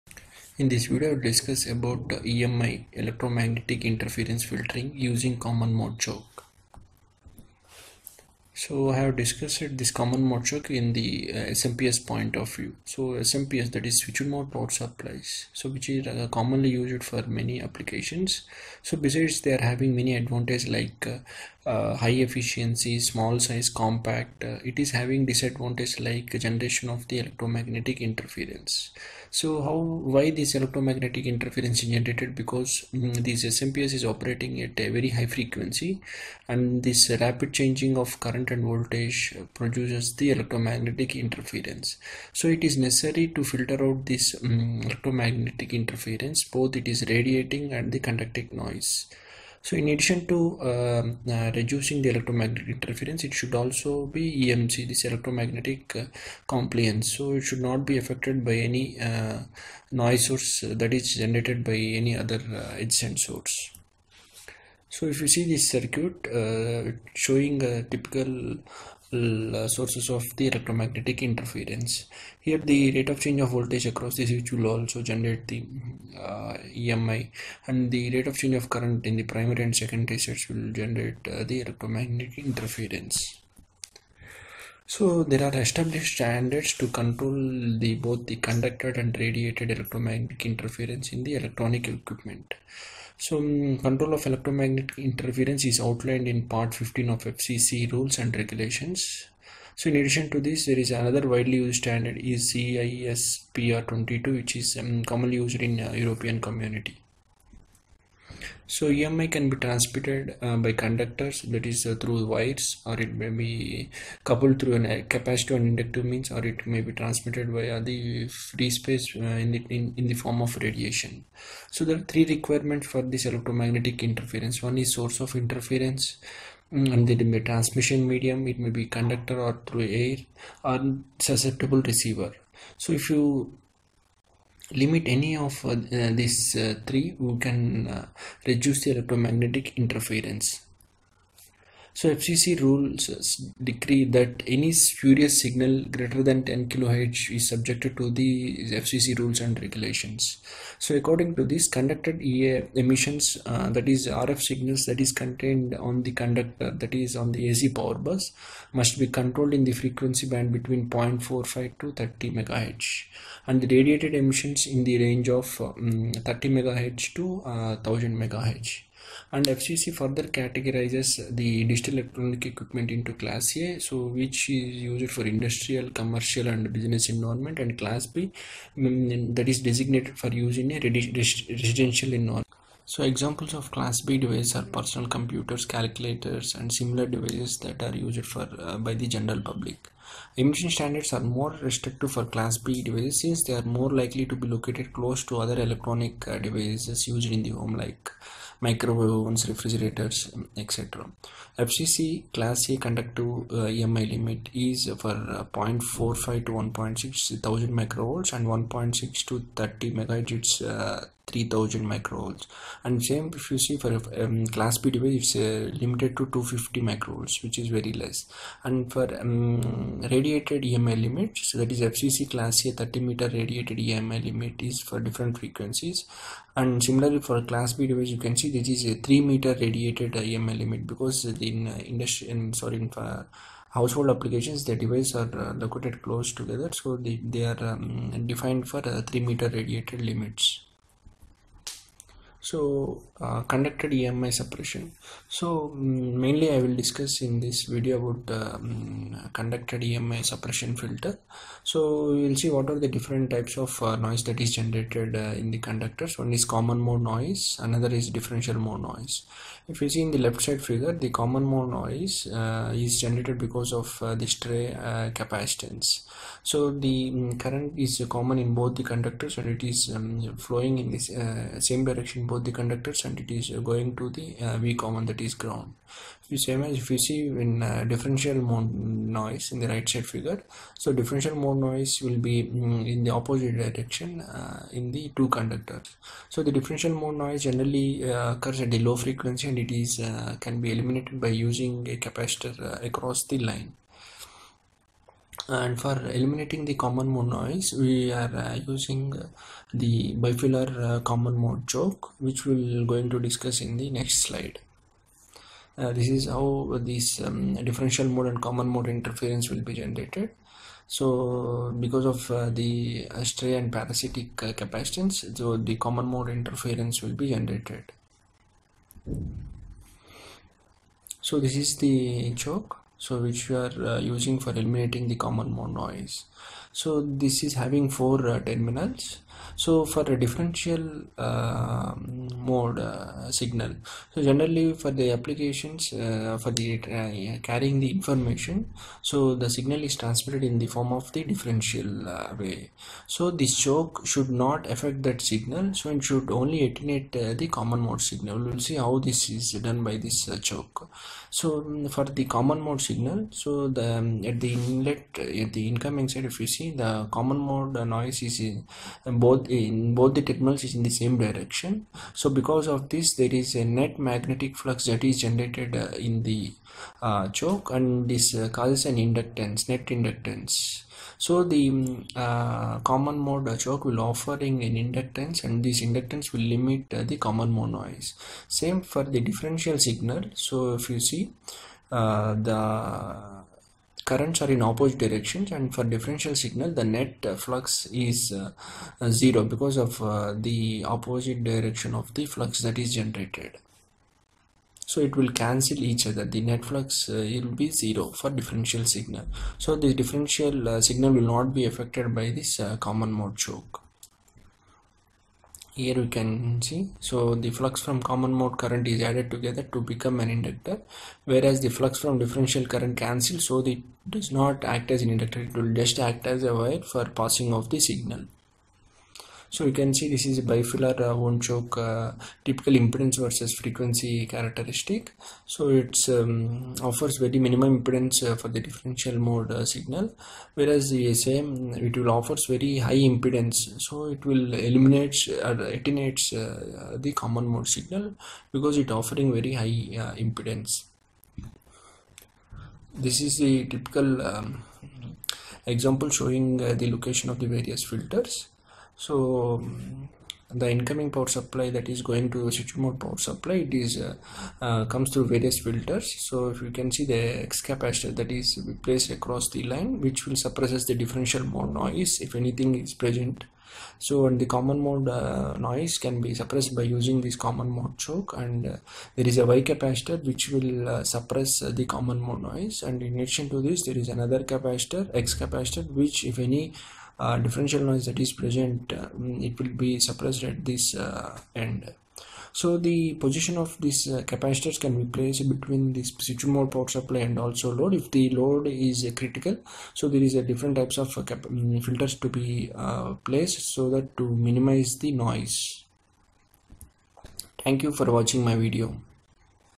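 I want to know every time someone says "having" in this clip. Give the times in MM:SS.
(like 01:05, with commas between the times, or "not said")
00:19, 00:24, 05:27.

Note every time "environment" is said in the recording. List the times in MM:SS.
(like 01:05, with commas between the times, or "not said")
02:57, 03:02.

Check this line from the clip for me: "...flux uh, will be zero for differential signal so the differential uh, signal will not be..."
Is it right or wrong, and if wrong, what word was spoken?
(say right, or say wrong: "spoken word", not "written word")
right.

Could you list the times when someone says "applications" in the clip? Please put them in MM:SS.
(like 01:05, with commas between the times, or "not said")
00:17, 03:54, 05:35.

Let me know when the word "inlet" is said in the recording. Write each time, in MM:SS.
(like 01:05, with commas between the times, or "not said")
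05:54.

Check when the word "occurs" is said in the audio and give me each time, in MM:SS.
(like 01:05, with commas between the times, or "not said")
04:48.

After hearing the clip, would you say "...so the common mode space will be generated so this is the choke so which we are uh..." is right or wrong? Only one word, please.
wrong.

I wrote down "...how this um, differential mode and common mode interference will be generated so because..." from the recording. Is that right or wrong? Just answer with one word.
right.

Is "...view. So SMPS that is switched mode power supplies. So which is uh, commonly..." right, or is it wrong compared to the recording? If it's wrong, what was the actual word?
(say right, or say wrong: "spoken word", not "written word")
right.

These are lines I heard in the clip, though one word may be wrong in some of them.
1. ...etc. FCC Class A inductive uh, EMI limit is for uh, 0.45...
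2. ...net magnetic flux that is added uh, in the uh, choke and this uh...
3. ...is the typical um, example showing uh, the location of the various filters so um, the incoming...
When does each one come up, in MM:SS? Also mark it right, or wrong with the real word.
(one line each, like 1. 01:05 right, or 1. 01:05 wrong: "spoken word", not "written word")
1. 03:20 wrong: "conductive", not "inductive"
2. 06:03 wrong: "generated", not "added"
3. 07:23 right.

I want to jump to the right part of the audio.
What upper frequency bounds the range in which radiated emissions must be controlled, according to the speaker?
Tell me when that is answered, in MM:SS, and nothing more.
02:47.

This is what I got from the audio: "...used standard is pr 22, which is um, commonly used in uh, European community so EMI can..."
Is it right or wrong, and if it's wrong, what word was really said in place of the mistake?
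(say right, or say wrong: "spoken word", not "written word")
right.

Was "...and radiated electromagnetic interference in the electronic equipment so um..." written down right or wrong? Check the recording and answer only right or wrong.
right.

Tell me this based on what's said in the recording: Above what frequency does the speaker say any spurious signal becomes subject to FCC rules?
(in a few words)
10 kHz.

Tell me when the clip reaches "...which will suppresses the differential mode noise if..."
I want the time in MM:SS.
07:40.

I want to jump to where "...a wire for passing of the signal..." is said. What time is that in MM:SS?
06:56.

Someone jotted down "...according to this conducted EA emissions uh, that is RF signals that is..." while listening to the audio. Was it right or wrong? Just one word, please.
right.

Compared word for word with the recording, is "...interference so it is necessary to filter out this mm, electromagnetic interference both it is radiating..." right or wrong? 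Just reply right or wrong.
right.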